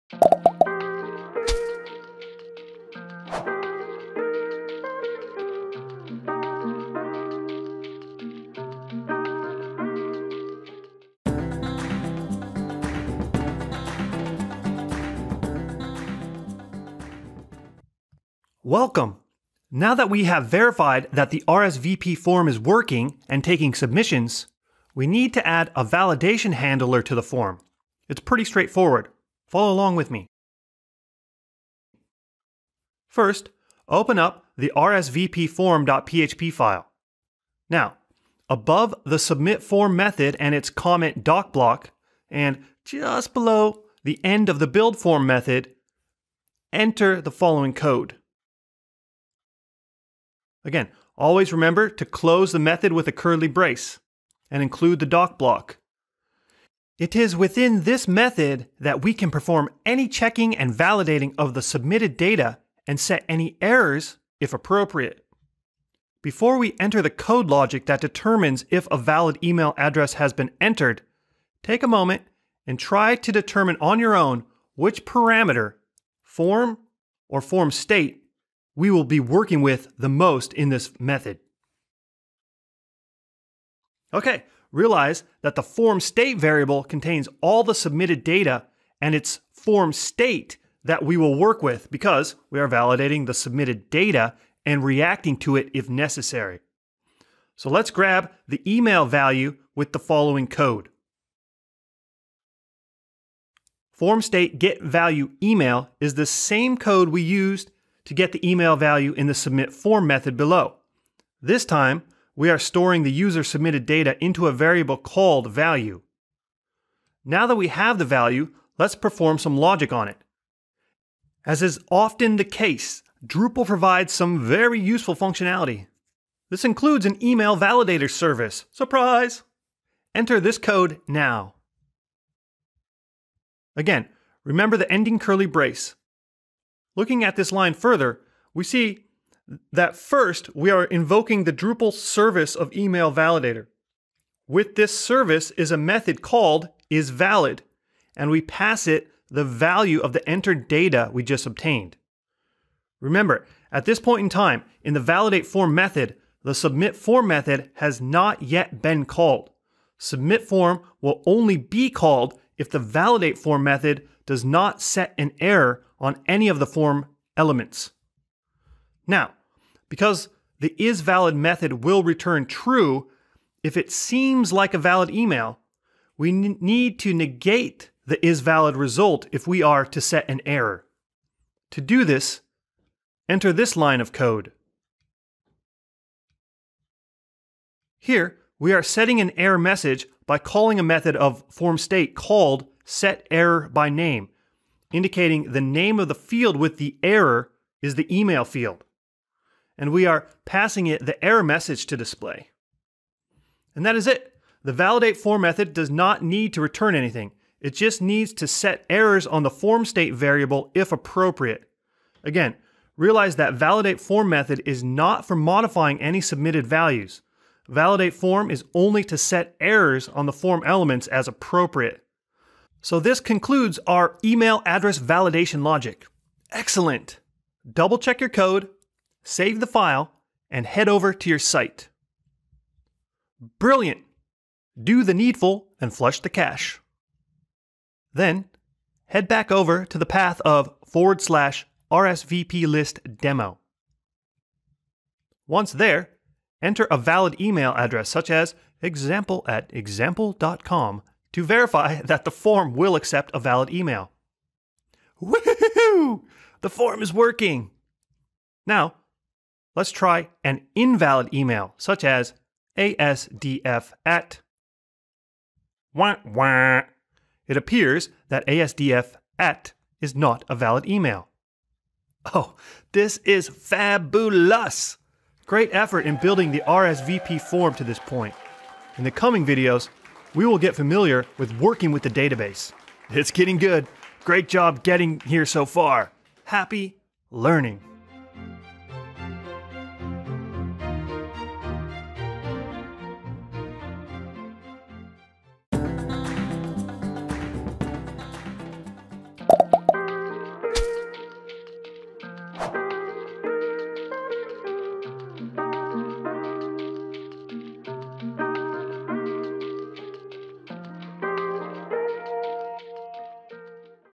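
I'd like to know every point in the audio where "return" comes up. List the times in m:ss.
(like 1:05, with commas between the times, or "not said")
2:52, 3:26.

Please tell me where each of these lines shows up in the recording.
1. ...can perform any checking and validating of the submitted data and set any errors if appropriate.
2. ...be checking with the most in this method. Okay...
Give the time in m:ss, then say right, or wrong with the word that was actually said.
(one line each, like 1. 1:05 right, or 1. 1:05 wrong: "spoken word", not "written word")
1. 0:59 right
2. 1:19 wrong: "working", not "checking".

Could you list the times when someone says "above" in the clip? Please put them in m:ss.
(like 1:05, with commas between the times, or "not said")
0:38.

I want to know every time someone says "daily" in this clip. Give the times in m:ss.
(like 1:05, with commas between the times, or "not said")
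not said.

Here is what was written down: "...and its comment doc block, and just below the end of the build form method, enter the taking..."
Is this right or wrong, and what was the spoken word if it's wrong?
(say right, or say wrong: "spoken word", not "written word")
wrong: "following", not "taking".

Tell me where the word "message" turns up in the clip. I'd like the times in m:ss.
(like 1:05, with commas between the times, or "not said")
3:09, 3:21.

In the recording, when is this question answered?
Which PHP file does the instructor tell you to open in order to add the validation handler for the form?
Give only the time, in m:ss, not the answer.
0:34.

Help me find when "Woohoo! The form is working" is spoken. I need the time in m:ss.
4:15.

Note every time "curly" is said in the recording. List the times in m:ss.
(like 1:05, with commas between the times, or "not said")
0:53, 2:15.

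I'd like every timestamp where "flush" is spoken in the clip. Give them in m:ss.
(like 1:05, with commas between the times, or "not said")
3:55.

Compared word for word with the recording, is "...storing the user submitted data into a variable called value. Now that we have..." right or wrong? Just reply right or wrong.
right.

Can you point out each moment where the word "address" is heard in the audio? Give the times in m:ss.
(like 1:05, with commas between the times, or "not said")
1:09, 3:44, 4:07.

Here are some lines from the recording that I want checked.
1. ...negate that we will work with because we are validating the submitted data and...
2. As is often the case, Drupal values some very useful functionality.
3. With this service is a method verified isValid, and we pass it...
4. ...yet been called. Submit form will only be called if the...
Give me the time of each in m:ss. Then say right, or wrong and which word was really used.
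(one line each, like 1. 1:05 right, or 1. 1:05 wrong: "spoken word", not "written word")
1. 1:29 wrong: "state", not "negate"
2. 2:01 wrong: "provides", not "values"
3. 2:24 wrong: "called", not "verified"
4. 2:38 right.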